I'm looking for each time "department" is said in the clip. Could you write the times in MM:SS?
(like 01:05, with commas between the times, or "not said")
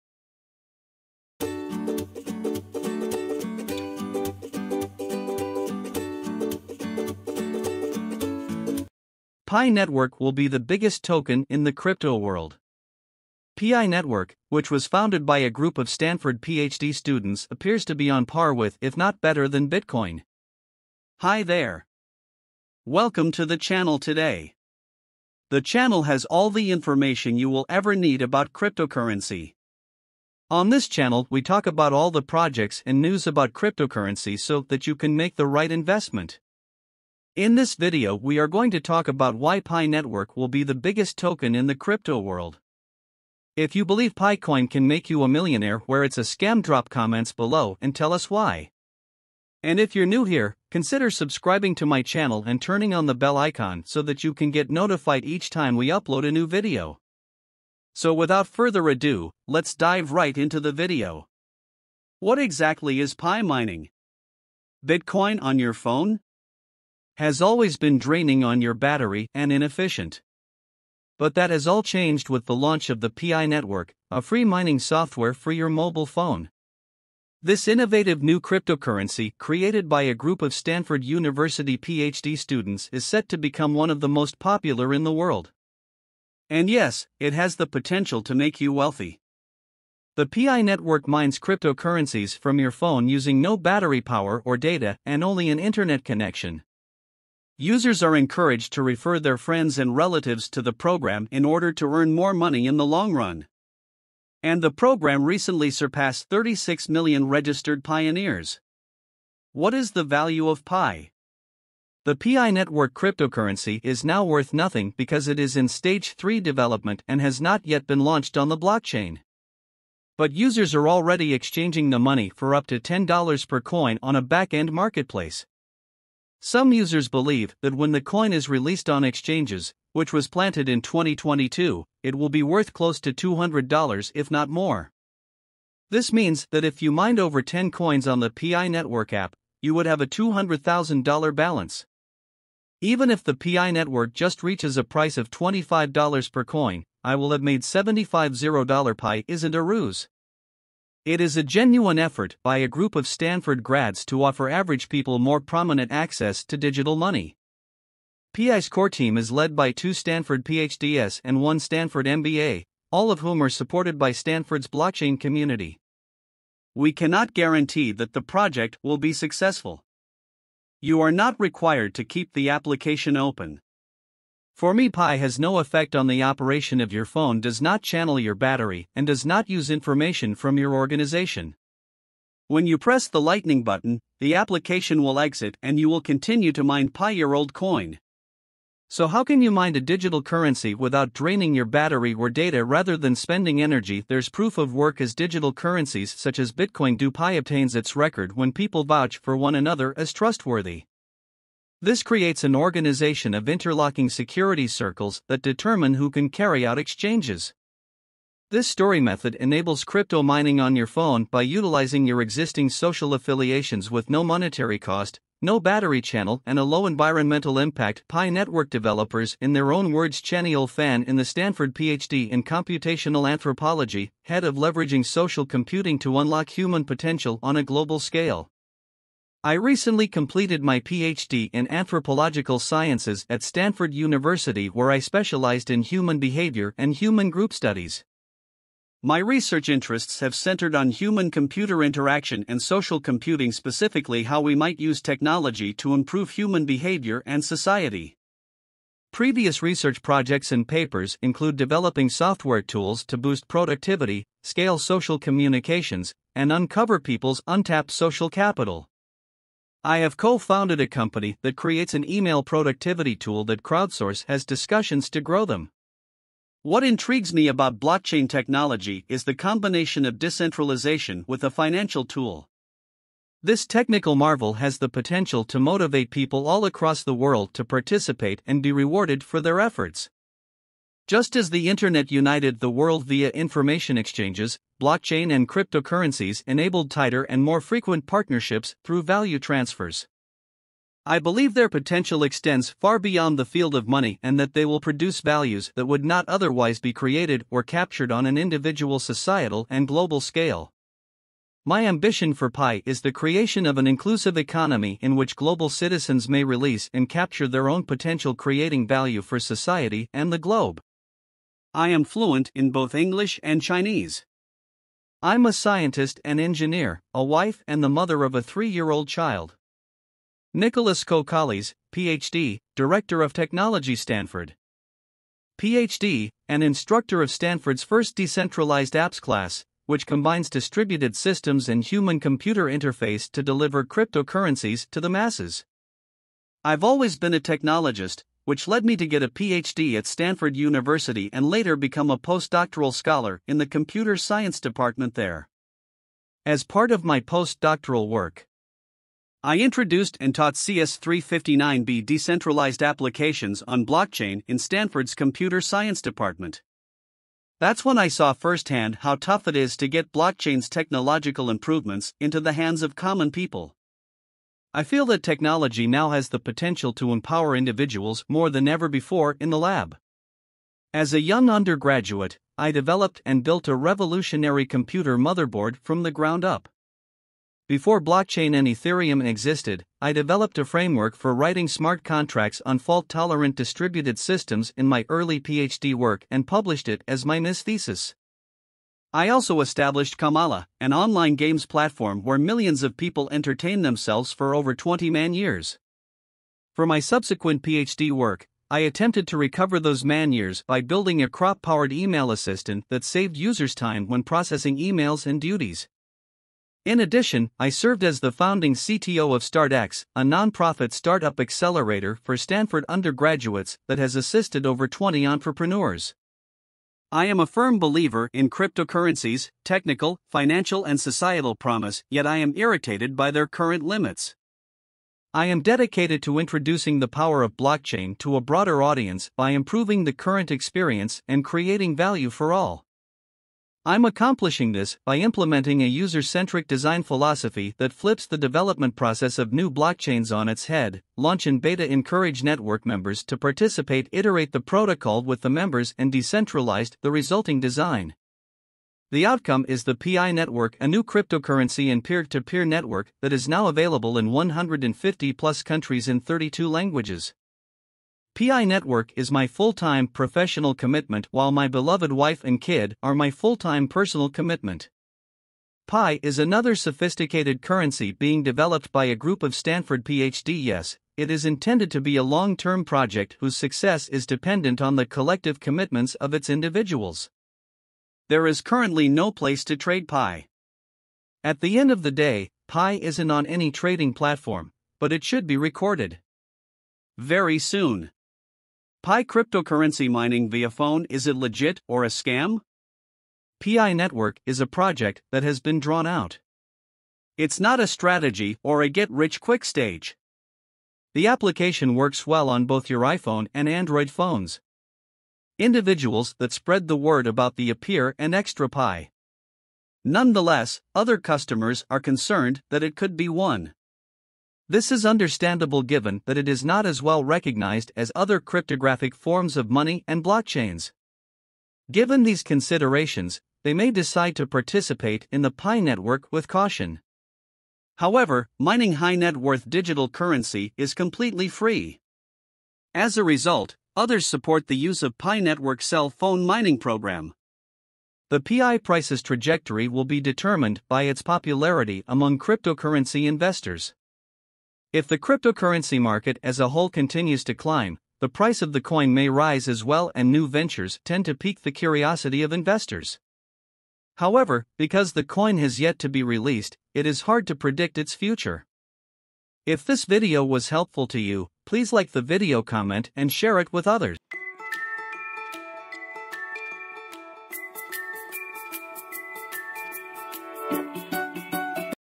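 05:44, 05:56.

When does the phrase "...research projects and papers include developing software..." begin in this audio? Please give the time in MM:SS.
04:09.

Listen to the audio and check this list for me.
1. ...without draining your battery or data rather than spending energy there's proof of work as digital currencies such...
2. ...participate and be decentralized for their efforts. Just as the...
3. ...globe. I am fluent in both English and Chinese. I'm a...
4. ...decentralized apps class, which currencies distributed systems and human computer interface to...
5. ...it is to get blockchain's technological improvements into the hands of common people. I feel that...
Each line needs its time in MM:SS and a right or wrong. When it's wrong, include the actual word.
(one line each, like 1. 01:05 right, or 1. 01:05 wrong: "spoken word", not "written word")
1. 03:10 right
2. 04:37 wrong: "rewarded", not "decentralized"
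3. 05:10 right
4. 05:28 wrong: "combines", not "currencies"
5. 05:59 right.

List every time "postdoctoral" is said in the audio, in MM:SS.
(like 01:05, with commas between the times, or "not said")
05:42, 05:47.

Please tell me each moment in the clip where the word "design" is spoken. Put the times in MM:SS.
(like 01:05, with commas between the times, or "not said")
07:16, 07:27.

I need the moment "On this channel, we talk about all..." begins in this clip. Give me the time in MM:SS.
00:30.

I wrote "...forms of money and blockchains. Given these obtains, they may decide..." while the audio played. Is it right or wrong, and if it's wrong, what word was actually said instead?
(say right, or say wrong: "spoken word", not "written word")
wrong: "considerations", not "obtains".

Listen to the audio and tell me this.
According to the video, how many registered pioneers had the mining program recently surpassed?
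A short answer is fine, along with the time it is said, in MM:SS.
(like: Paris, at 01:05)
36 million, at 01:46.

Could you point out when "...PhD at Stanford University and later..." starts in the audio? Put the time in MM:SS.
05:39.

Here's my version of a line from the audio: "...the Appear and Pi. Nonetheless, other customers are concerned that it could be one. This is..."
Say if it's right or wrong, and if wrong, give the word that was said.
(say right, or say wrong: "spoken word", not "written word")
right.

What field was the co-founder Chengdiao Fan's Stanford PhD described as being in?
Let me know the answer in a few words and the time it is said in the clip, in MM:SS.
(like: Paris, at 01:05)
computational anthropology, at 03:42.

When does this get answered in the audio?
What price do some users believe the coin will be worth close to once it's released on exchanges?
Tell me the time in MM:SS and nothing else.
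02:13.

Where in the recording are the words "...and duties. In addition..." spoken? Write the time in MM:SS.
06:45.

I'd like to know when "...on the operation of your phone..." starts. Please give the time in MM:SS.
02:55.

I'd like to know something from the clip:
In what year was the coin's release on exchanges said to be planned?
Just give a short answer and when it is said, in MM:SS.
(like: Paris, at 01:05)
2022, at 02:10.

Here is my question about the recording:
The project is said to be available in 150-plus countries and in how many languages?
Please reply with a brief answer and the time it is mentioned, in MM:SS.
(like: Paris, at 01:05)
32, at 07:36.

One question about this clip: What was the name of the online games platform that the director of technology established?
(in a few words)
Kamala.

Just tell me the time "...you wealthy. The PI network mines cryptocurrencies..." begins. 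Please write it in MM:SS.
01:28.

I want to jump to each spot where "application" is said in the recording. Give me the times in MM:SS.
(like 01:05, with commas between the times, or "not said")
02:52, 03:04, 05:52, 08:21.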